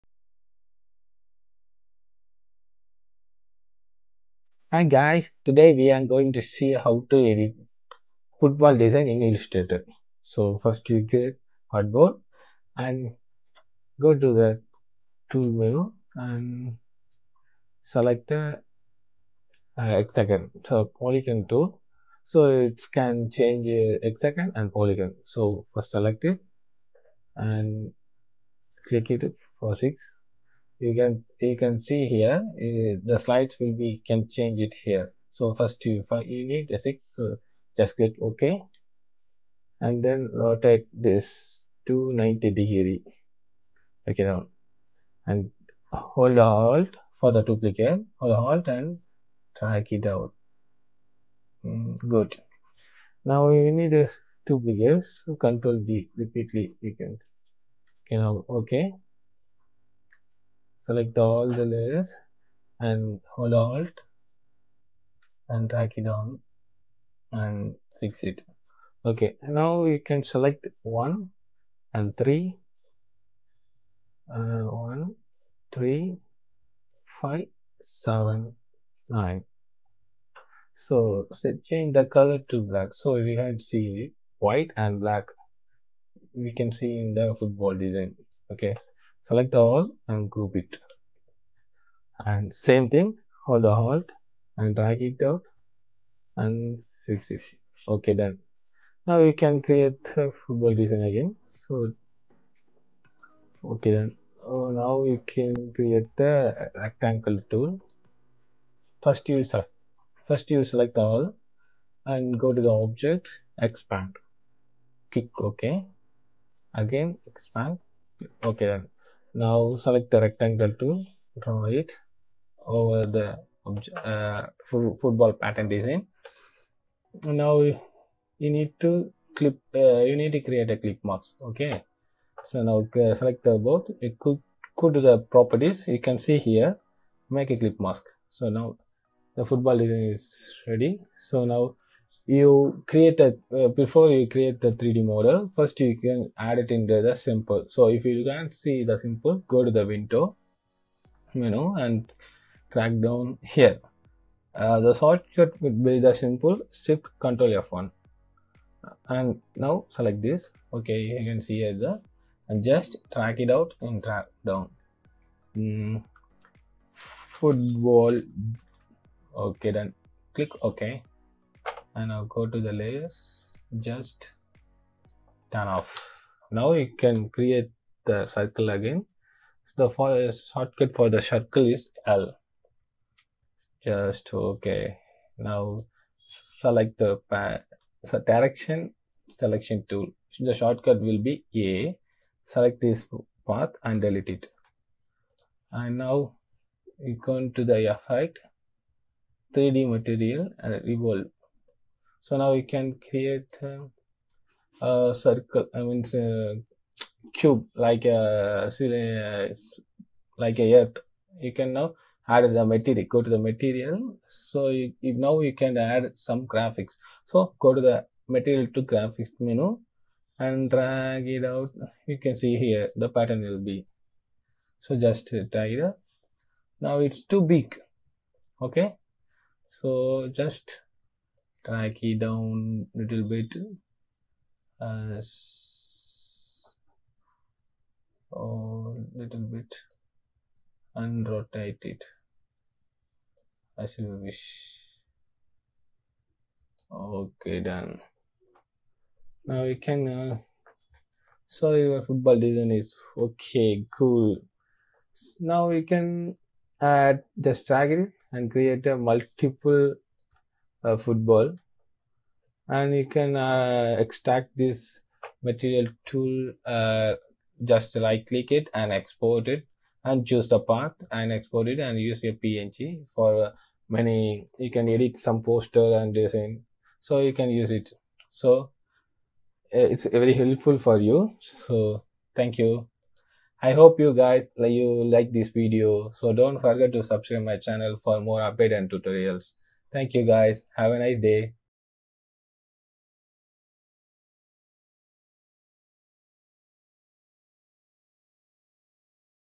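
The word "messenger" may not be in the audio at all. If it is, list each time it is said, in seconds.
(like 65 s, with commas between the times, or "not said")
not said.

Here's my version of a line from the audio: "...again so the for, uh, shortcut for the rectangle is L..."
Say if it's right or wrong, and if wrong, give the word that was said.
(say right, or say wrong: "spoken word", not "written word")
wrong: "circle", not "rectangle".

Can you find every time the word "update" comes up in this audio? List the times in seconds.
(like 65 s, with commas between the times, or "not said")
288 s.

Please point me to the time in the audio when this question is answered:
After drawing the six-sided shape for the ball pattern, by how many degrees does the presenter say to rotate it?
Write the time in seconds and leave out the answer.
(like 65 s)
41 s.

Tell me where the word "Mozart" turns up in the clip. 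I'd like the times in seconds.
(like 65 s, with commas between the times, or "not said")
not said.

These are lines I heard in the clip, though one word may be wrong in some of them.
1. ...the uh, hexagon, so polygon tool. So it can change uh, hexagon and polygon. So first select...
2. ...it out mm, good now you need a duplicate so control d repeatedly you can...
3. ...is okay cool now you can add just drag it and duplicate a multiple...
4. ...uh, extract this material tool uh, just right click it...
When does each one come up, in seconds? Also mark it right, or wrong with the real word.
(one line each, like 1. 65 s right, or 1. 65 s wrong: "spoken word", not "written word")
1. 18 s right
2. 49 s right
3. 252 s wrong: "create", not "duplicate"
4. 263 s right.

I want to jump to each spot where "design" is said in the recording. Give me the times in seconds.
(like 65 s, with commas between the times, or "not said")
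8 s, 87 s, 100 s, 125 s, 139 s, 252 s, 276 s.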